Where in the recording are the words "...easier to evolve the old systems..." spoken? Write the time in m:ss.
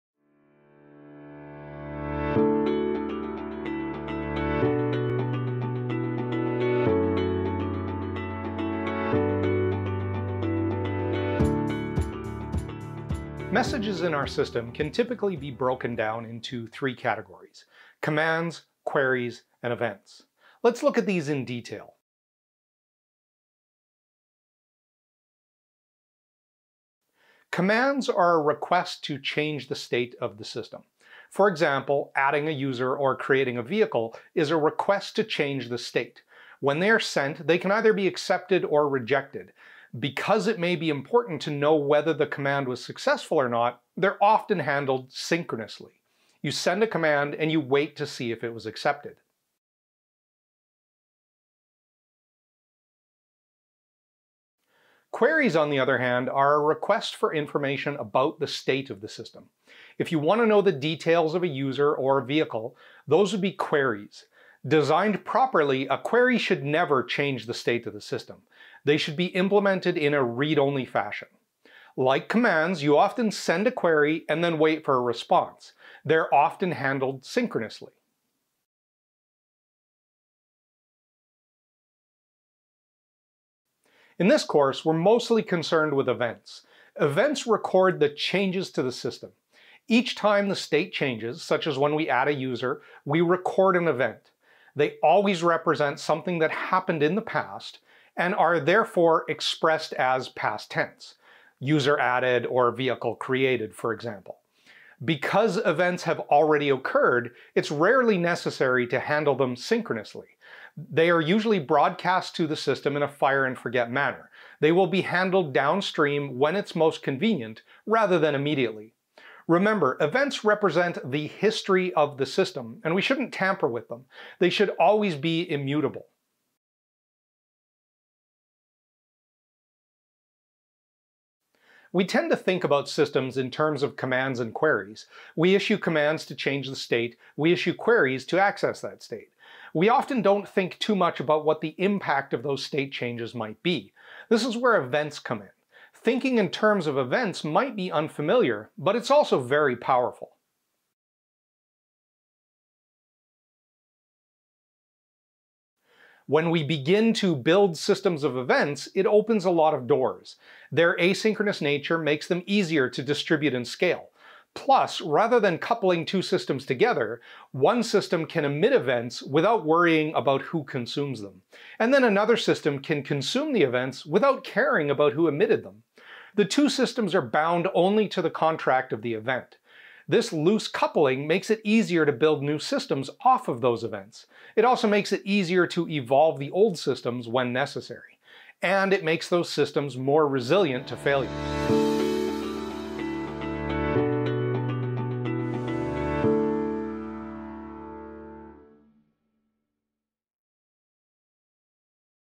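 3:05.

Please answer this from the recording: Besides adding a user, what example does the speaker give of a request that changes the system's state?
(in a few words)
creating a vehicle.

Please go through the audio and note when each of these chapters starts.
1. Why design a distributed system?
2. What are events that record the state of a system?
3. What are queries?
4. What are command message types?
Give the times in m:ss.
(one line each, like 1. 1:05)
1. 2:34
2. 1:22
3. 0:50
4. 0:26.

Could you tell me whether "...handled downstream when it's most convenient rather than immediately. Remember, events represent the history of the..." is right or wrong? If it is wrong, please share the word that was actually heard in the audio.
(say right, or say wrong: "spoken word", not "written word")
right.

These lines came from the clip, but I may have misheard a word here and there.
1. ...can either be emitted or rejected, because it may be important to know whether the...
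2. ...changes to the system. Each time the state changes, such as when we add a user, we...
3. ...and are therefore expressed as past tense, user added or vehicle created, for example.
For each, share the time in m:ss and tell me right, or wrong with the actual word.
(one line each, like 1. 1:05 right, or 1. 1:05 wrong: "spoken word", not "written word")
1. 0:37 wrong: "accepted", not "emitted"
2. 1:28 right
3. 1:38 right.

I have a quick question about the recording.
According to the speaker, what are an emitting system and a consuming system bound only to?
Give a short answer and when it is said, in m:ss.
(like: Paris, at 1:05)
the contract of the event, at 2:58.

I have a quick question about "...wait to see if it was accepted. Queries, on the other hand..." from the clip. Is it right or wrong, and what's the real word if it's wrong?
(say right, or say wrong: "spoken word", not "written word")
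right.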